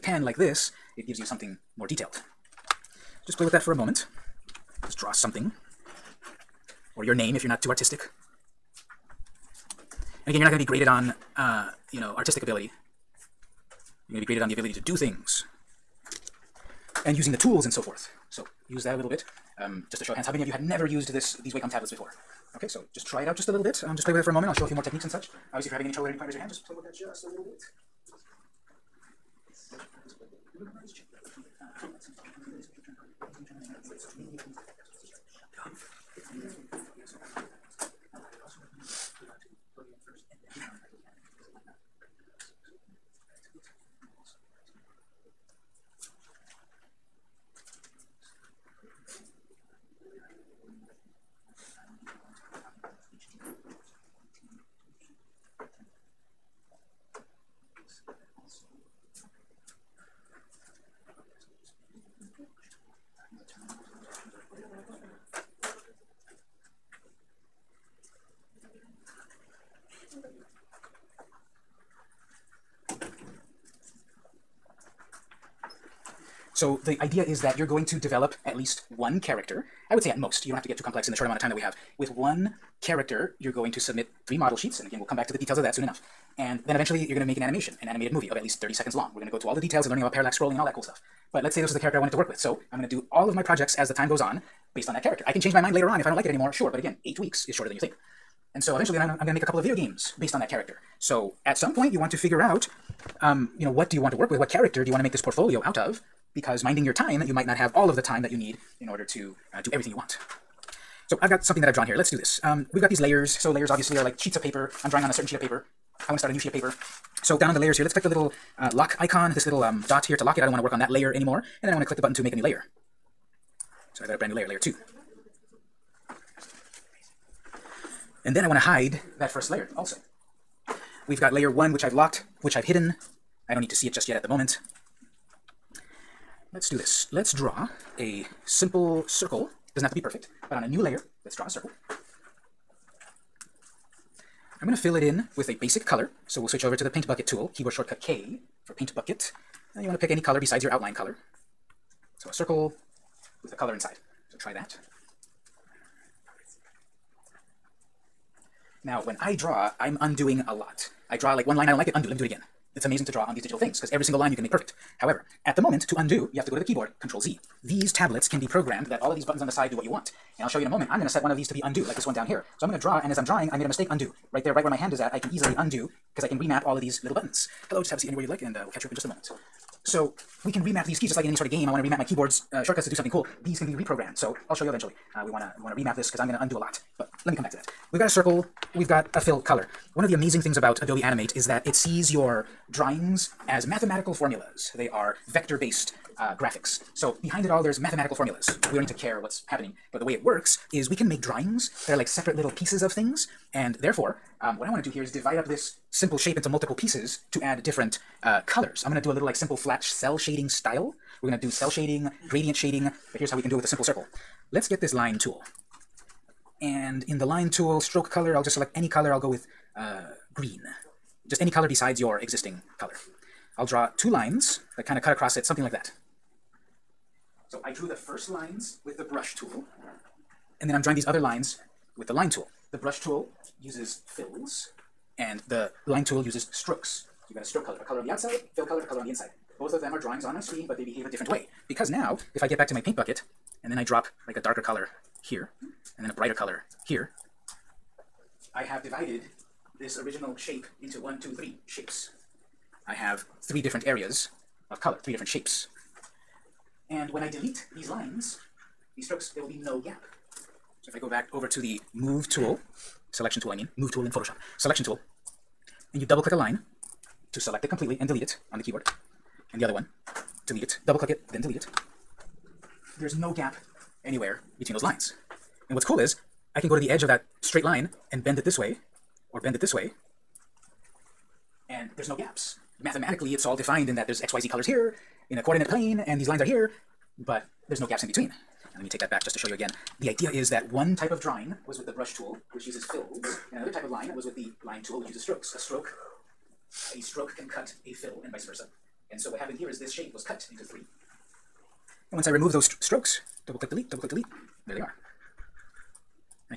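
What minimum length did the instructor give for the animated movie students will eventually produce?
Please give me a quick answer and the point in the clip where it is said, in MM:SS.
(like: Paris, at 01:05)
30 seconds, at 01:28.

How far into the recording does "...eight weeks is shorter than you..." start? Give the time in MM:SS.
01:37.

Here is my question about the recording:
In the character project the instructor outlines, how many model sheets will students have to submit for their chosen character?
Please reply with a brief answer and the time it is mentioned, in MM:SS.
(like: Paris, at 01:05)
3, at 01:24.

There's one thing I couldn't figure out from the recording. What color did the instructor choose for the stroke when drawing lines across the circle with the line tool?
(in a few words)
Green.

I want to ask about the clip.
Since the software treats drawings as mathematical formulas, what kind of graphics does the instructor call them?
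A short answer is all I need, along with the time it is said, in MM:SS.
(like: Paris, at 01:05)
Vector-based, at 03:15.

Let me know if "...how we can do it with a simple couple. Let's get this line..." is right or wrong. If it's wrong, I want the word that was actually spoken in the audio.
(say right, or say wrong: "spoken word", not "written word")
wrong: "circle", not "couple".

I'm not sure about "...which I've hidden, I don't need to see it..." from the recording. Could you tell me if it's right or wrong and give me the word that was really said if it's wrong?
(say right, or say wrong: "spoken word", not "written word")
right.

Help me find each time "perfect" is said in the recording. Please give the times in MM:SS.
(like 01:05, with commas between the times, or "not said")
02:20, 02:44.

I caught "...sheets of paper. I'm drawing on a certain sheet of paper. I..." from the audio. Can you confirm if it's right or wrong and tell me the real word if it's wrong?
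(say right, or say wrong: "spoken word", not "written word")
right.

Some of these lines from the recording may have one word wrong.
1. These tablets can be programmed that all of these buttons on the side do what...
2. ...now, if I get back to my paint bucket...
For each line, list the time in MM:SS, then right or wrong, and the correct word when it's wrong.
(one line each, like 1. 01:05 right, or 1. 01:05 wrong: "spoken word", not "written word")
1. 02:47 right
2. 04:01 right.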